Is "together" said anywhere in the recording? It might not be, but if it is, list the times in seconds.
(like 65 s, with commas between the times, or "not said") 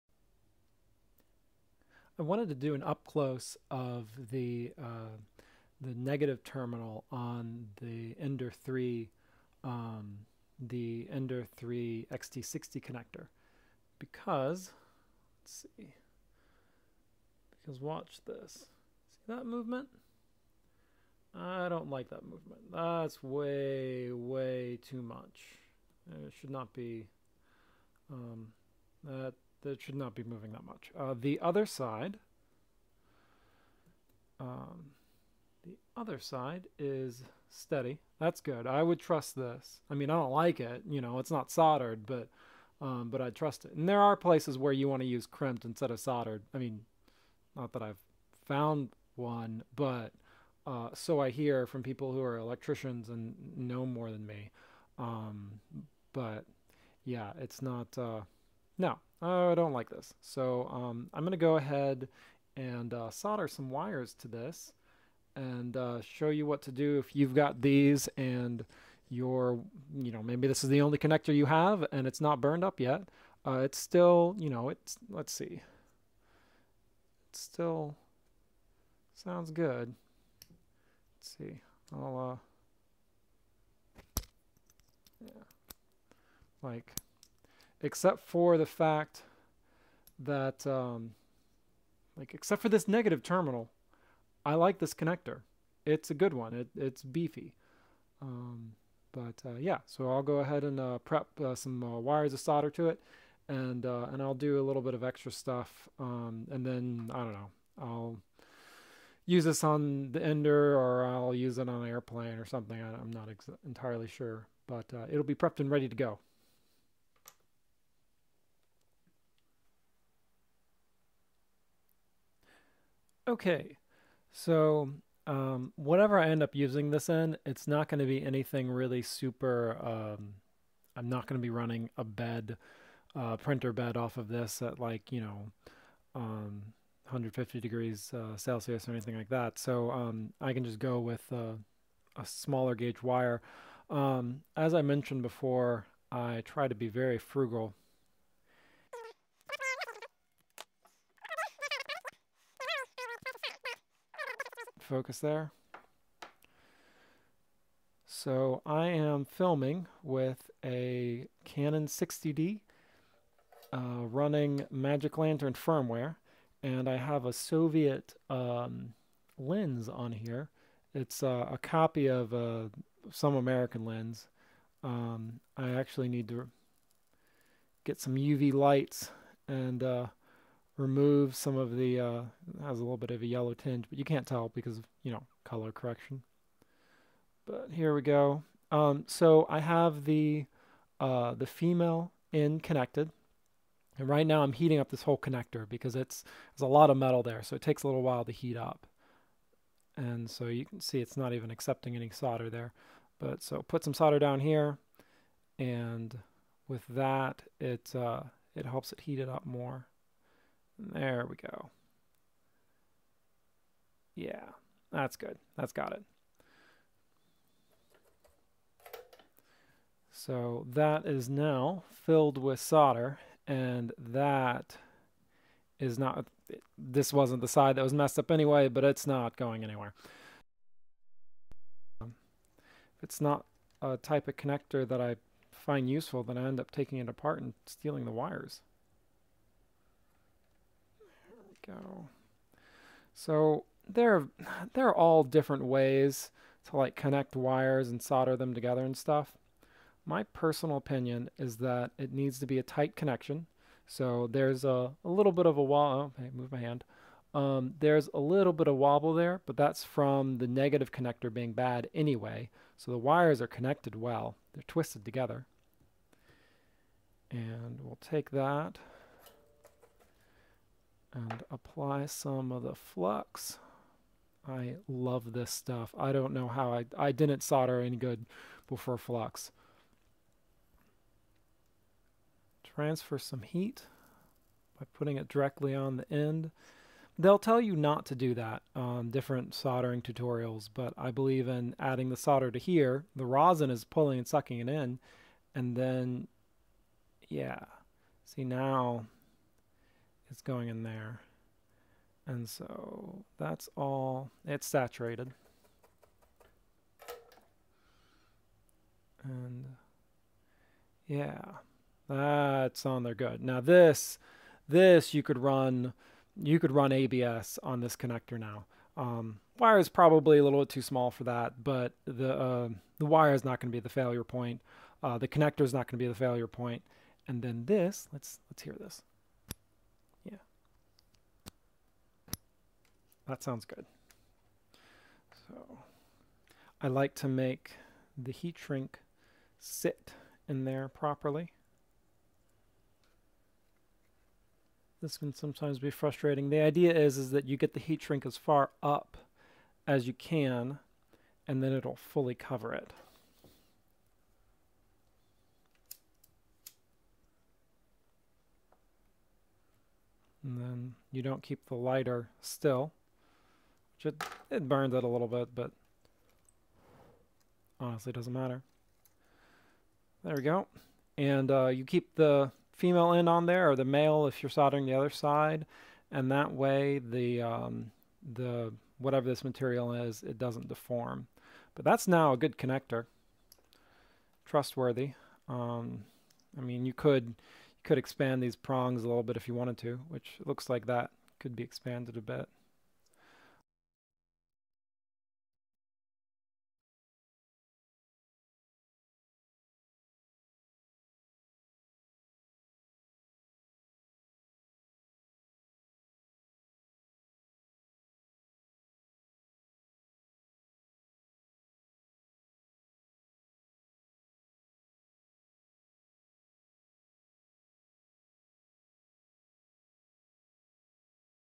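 248 s, 265 s.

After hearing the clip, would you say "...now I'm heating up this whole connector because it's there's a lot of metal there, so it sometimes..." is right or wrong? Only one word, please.
wrong.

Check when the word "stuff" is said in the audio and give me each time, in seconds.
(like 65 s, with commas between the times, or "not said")
105 s, 248 s, 275 s.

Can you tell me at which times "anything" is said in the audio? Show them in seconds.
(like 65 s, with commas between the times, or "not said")
128 s, 138 s.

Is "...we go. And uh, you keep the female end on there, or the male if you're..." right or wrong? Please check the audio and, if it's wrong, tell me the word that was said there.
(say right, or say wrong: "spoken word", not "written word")
right.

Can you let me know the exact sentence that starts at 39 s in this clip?
I mean, I don't like it.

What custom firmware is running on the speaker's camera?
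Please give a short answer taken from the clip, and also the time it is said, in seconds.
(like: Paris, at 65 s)
Magic Lantern, at 164 s.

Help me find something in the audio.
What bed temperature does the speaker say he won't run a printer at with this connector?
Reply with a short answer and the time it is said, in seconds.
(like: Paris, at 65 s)
150 degrees Celsius, at 137 s.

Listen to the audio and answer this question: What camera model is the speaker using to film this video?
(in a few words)
Canon 60D.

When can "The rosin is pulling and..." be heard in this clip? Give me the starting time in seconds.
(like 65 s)
293 s.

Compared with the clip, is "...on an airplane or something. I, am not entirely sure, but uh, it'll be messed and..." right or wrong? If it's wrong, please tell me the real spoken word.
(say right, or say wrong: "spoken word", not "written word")
wrong: "prepped", not "messed".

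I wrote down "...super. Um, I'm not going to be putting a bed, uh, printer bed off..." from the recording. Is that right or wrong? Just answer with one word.
wrong.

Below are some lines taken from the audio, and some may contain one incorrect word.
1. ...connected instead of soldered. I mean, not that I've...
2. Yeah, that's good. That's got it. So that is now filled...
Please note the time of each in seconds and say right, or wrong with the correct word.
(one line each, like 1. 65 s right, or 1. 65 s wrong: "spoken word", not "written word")
1. 45 s wrong: "crimped", not "connected"
2. 214 s right.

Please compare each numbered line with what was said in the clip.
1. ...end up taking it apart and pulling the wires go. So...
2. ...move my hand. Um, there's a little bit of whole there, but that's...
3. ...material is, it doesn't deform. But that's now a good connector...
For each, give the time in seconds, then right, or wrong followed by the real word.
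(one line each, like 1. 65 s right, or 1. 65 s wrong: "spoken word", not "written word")
1. 236 s wrong: "stealing", not "pulling"
2. 256 s wrong: "wobble", not "whole"
3. 379 s right.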